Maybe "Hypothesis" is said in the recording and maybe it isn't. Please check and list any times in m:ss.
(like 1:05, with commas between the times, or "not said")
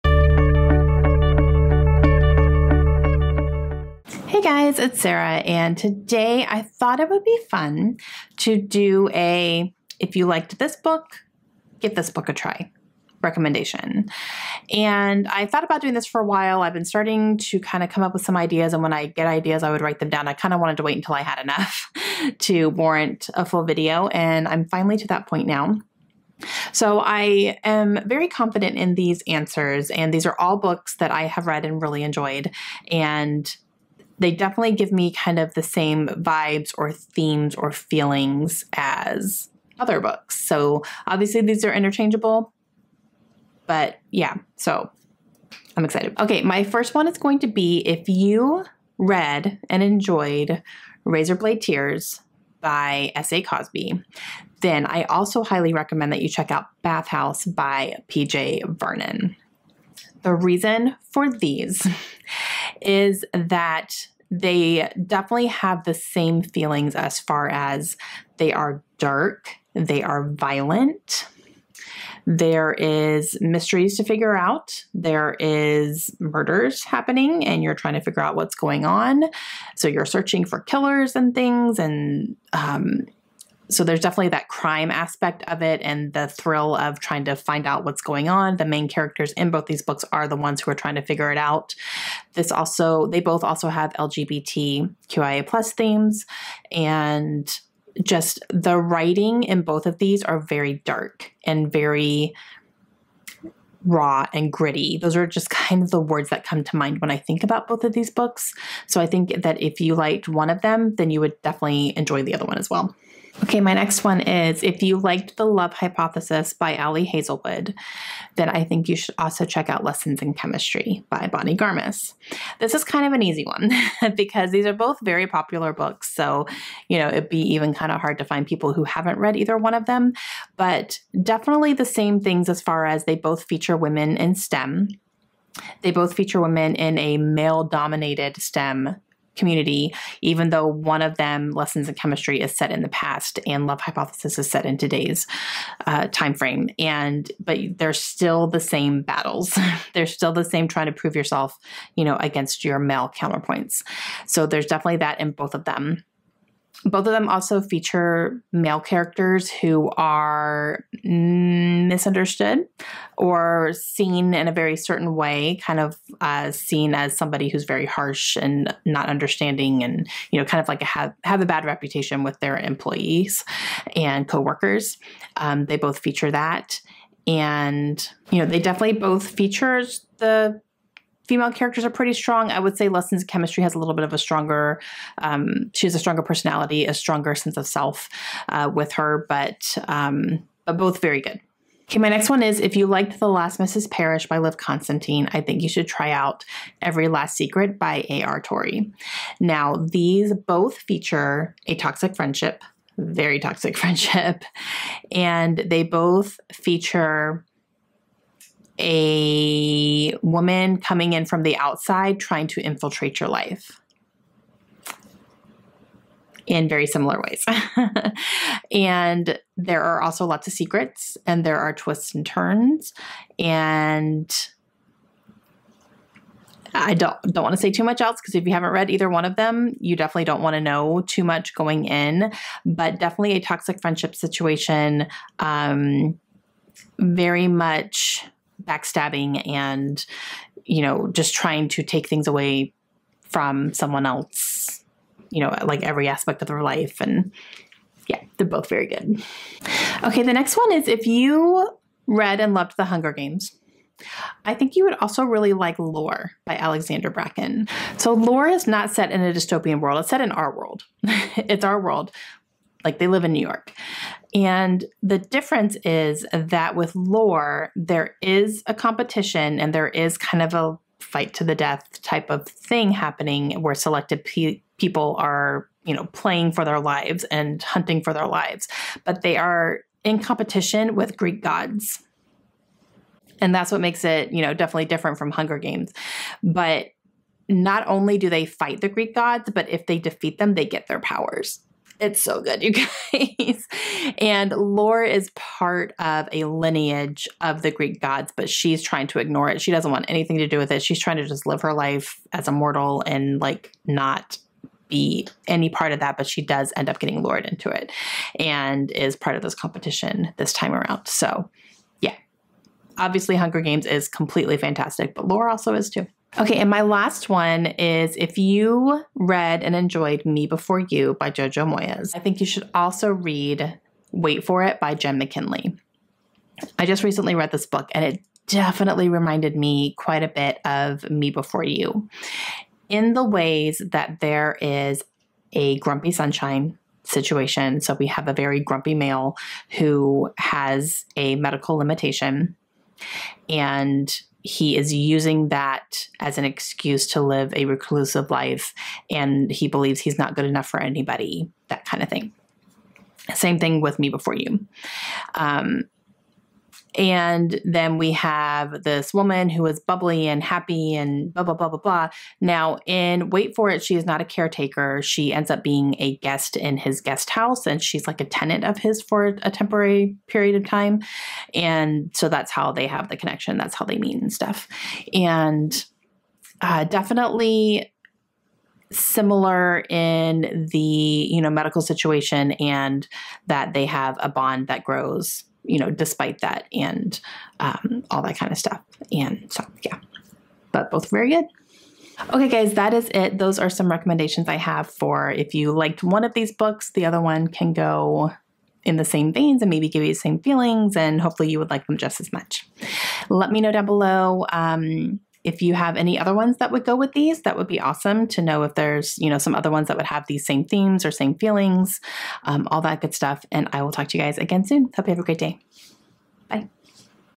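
1:55, 2:23.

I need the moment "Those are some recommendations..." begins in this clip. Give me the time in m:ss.
6:33.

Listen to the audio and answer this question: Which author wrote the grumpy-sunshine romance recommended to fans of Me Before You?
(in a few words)
Jenn McKinlay.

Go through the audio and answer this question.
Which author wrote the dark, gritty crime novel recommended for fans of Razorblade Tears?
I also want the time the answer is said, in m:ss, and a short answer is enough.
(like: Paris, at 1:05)
P.J. Vernon, at 0:58.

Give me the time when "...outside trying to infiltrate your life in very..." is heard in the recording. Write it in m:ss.
3:31.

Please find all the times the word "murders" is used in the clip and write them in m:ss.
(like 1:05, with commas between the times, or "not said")
1:16.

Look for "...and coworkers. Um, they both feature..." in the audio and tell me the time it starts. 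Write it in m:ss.
2:53.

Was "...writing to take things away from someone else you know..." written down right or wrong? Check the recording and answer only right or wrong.
wrong.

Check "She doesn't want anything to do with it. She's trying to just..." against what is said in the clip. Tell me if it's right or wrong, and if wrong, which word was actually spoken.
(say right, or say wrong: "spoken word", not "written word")
right.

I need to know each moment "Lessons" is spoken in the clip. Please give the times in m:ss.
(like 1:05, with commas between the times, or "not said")
1:59, 2:21, 3:02.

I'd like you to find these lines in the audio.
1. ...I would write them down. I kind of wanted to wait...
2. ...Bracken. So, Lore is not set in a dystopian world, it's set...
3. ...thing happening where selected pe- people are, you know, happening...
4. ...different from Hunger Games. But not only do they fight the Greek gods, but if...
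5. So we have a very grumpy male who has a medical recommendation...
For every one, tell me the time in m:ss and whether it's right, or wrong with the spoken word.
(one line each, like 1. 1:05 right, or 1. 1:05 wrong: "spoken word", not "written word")
1. 0:19 right
2. 4:17 right
3. 4:32 wrong: "playing", not "happening"
4. 4:44 right
5. 5:37 wrong: "limitation", not "recommendation".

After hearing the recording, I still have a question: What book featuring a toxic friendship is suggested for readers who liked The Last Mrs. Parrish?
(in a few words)
Every Last Secret.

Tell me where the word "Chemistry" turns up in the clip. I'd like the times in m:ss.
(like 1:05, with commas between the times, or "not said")
2:00, 2:21, 3:03.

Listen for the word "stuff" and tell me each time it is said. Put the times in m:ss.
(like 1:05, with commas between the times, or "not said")
6:14, 6:28, 6:53.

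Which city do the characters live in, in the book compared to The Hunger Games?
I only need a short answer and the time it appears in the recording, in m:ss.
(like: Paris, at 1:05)
New York, at 4:23.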